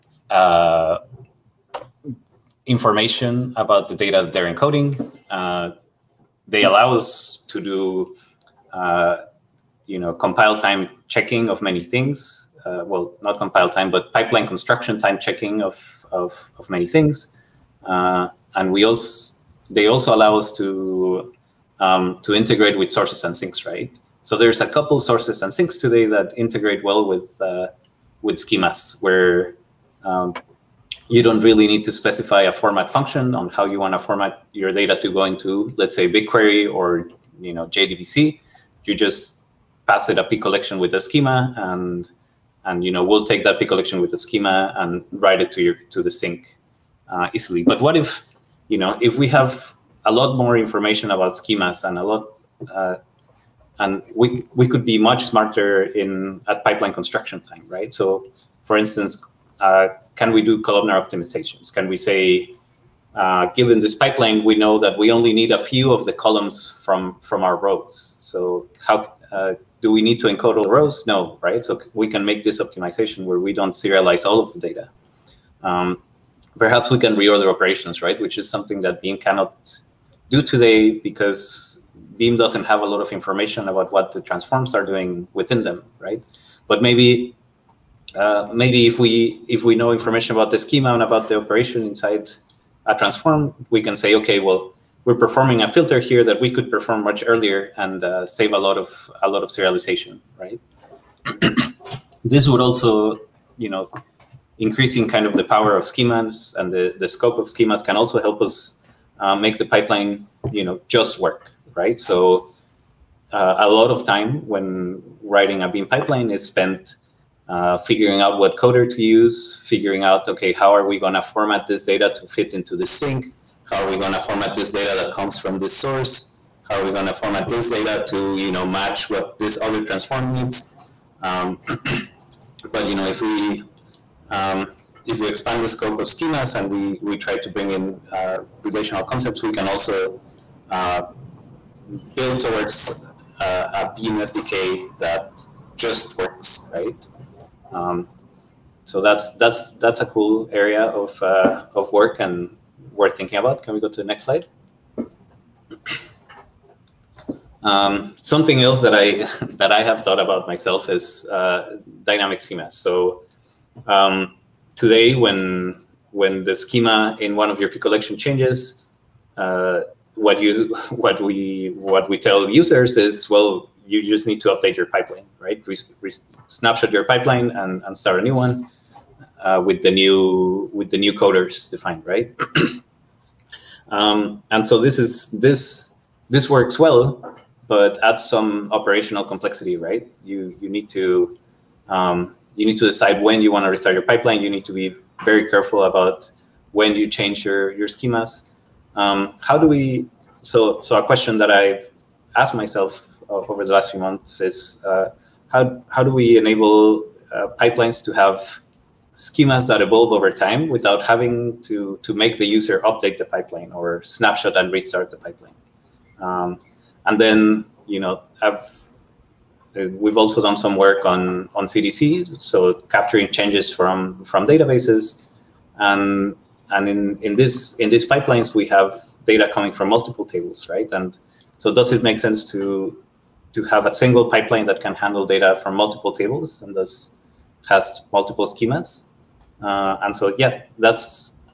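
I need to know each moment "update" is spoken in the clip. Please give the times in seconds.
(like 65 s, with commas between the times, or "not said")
174 s, 212 s.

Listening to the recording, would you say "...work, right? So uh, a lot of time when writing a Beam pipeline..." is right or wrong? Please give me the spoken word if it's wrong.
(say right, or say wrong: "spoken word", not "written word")
right.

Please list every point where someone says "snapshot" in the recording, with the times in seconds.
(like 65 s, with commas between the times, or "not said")
176 s, 214 s.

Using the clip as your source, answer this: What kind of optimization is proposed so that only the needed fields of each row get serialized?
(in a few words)
Columnar optimizations.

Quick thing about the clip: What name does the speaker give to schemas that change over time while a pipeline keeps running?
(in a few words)
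Dynamic schemas.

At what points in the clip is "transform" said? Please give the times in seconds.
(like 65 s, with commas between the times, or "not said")
84 s, 92 s, 129 s.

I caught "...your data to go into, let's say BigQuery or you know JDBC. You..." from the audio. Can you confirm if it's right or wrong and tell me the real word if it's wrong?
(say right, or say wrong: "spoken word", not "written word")
right.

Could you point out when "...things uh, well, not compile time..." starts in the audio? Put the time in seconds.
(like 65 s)
11 s.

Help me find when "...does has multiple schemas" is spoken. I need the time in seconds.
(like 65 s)
236 s.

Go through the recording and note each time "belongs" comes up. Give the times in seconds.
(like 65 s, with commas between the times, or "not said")
not said.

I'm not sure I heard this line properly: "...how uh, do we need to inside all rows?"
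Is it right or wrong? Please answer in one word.
wrong.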